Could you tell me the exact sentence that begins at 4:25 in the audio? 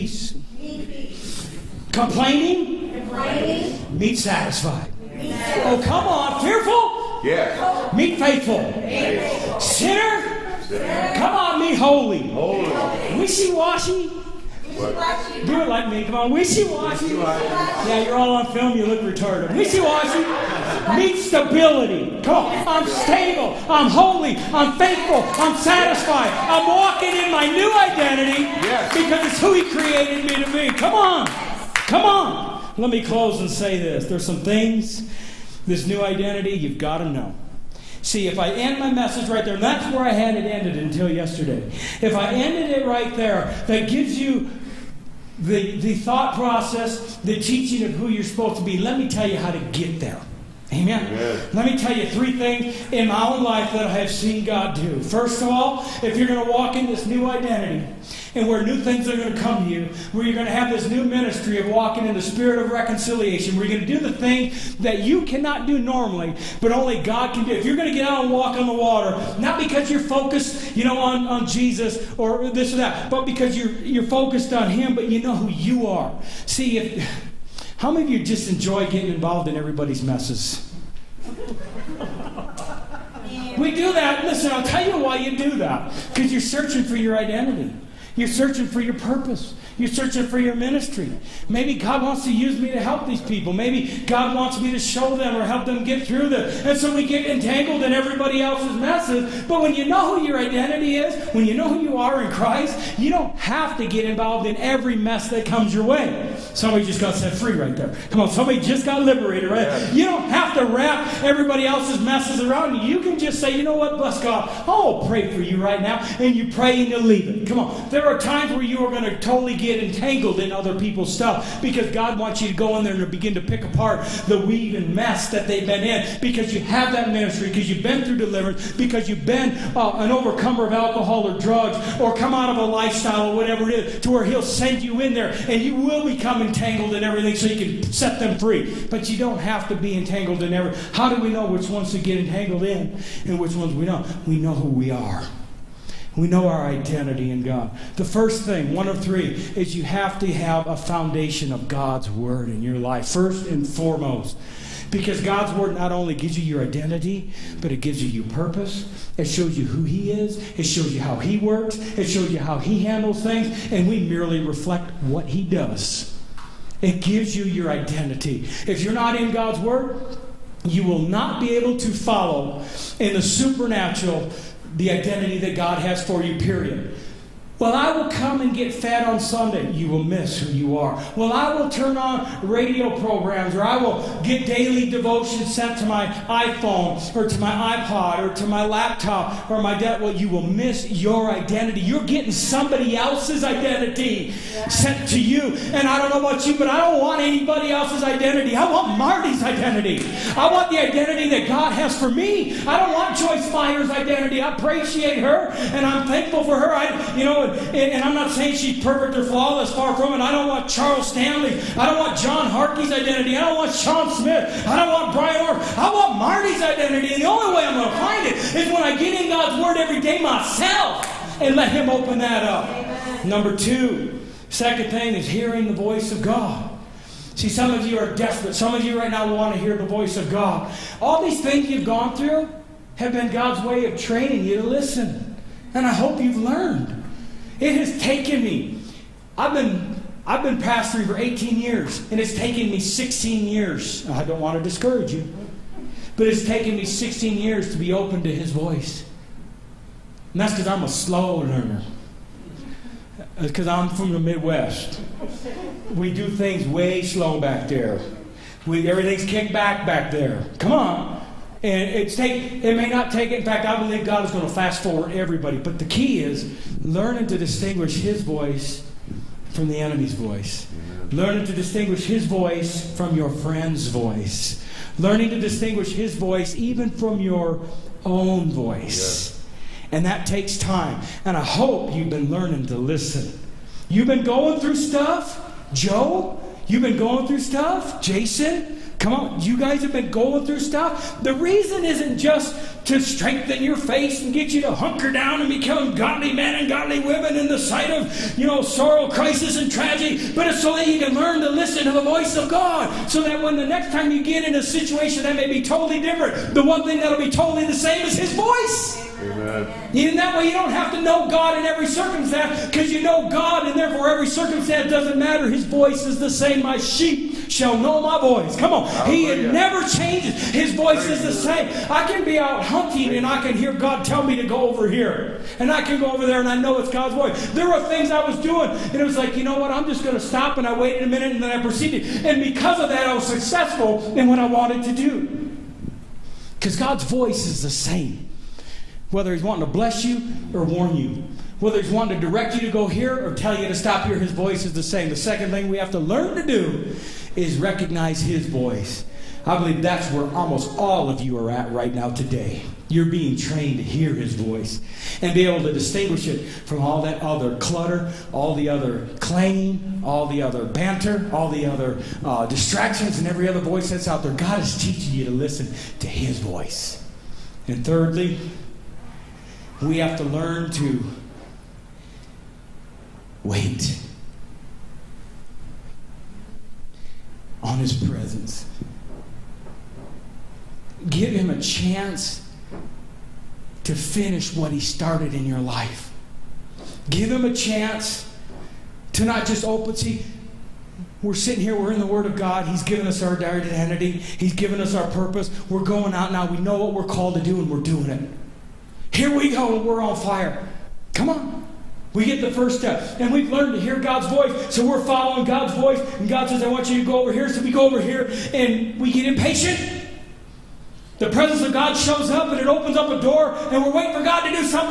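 But the key is learning to distinguish His voice from the enemy's voice.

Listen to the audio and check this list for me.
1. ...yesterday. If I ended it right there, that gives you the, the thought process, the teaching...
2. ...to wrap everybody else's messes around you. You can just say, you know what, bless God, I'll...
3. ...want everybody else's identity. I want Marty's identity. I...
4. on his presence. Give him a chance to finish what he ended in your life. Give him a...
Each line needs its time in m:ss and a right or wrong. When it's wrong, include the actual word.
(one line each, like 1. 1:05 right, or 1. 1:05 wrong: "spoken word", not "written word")
1. 0:41 right
2. 1:50 right
3. 3:17 wrong: "anybody", not "everybody"
4. 6:17 wrong: "started", not "ended".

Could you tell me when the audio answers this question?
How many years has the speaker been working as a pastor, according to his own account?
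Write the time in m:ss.
4:01.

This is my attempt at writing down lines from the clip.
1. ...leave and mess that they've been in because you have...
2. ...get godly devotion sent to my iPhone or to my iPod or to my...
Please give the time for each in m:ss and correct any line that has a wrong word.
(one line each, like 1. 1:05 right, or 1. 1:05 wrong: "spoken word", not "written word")
1. 2:04 wrong: "weave", not "leave"
2. 3:04 wrong: "daily", not "godly".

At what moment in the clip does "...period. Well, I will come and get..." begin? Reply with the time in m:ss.
2:56.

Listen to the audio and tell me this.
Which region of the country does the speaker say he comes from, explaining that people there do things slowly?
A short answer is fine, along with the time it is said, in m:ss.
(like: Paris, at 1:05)
the Midwest, at 4:14.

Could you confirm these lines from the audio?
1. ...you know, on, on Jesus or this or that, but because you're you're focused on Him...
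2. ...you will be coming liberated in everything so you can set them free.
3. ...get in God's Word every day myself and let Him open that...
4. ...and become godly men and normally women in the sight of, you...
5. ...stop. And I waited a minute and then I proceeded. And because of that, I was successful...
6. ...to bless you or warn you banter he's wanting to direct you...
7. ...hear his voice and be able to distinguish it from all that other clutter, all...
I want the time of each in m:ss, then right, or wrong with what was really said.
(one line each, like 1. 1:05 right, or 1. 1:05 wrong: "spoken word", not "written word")
1. 1:10 right
2. 2:15 wrong: "entangled", not "liberated"
3. 3:38 right
4. 4:55 wrong: "godly", not "normally"
5. 5:30 right
6. 5:39 wrong: "whether", not "banter"
7. 5:53 right.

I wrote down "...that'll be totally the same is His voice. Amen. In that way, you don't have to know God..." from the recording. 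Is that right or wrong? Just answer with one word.
right.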